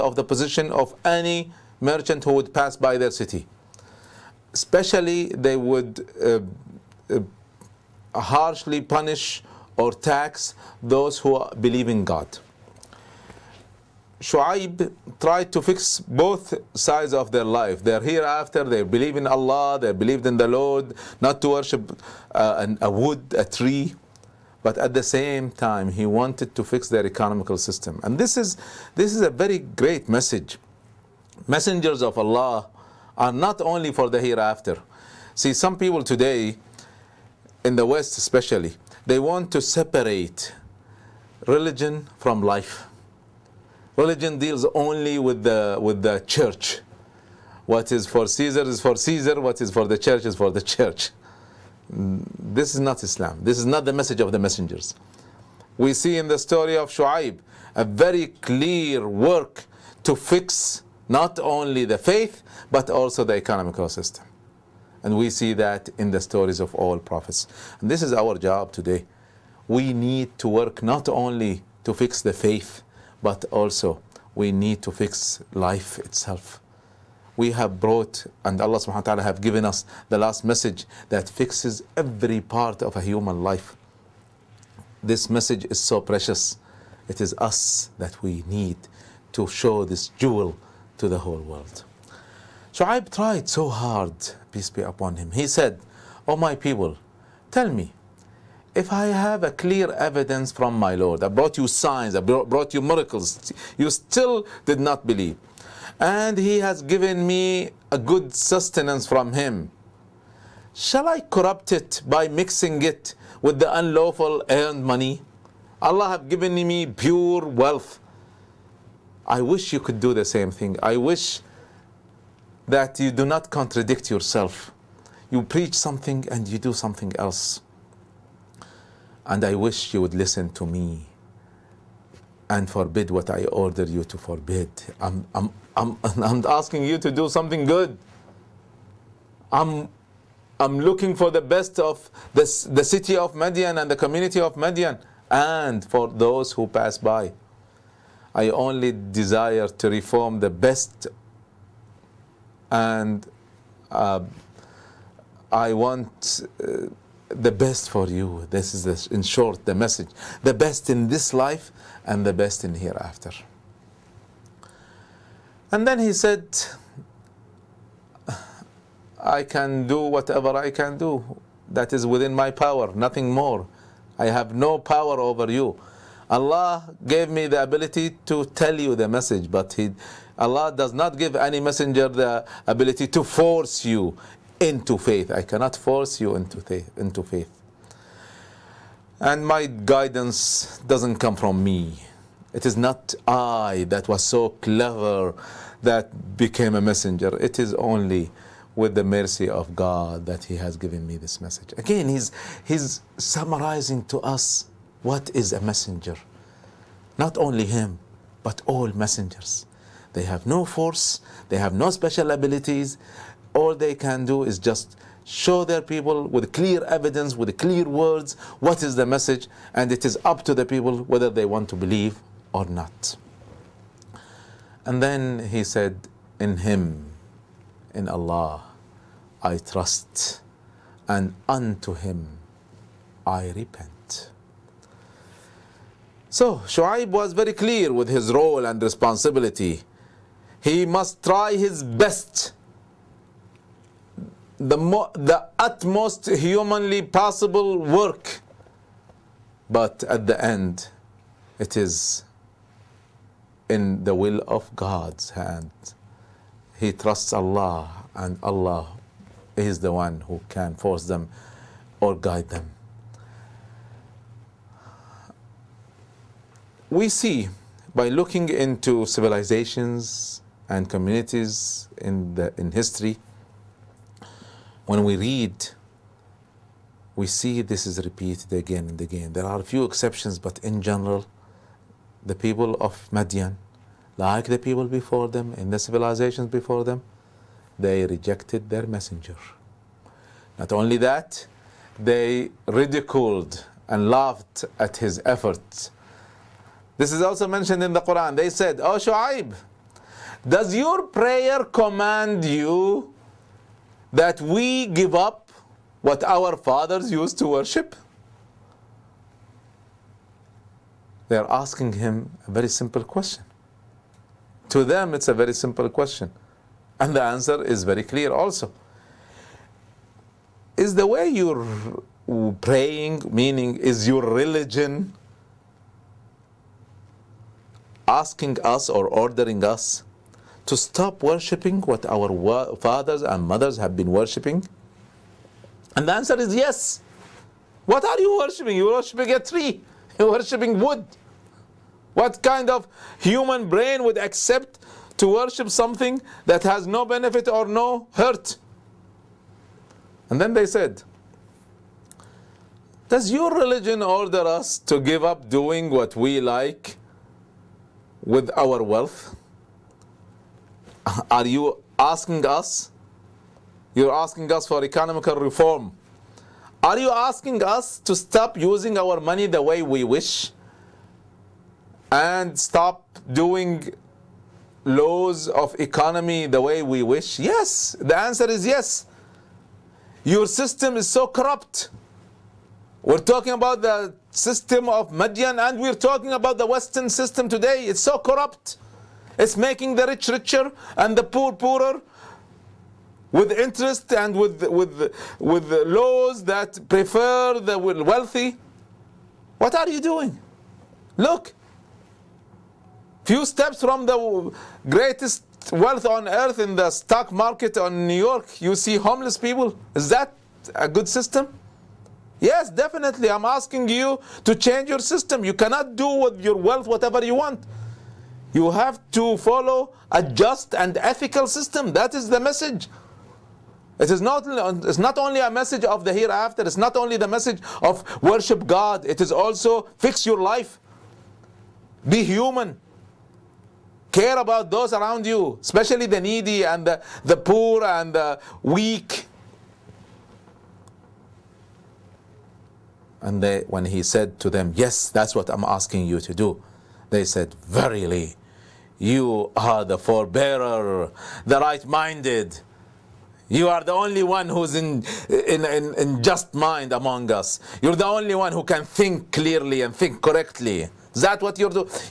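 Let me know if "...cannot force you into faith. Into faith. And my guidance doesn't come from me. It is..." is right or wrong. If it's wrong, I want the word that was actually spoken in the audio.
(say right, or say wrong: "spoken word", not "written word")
right.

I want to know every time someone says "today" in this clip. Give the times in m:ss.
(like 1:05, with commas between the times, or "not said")
0:36, 1:08, 6:27.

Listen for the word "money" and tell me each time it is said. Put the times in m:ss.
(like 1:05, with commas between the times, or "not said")
1:54, 6:09.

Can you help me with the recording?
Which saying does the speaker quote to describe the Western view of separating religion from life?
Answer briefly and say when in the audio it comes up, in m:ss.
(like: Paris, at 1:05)
What is for Caesar is for Caesar, at 0:47.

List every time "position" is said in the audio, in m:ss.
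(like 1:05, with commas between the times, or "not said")
0:00.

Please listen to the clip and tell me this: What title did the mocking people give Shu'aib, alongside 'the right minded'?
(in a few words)
The forbearer.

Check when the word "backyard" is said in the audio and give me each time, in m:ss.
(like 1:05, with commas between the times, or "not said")
not said.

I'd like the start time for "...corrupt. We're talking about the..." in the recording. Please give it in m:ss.
6:21.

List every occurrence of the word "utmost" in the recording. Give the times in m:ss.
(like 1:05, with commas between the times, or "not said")
4:05.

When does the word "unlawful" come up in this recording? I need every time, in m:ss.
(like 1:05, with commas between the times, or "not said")
1:53.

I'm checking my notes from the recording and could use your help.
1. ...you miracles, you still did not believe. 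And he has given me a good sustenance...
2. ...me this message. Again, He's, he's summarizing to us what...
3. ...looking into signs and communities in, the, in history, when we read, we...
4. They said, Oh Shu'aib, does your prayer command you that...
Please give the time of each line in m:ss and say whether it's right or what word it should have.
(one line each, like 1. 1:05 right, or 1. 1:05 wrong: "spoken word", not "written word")
1. 1:42 right
2. 3:21 right
3. 4:28 wrong: "civilizations", not "signs"
4. 4:58 right.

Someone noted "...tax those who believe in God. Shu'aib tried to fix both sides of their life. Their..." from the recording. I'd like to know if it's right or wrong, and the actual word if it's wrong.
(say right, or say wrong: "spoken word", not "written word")
right.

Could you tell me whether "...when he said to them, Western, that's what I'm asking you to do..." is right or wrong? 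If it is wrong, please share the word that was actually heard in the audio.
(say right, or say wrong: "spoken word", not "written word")
wrong: "Yes", not "Western".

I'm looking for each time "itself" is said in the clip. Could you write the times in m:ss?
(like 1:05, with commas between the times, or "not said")
1:15.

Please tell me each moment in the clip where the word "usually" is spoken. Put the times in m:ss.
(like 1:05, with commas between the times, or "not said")
not said.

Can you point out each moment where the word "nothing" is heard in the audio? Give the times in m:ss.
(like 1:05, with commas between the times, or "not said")
2:52.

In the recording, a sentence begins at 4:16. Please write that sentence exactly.
He trusts Allah, and Allah is the one who can force them or guide them.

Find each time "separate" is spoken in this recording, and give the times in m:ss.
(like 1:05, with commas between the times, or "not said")
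0:39.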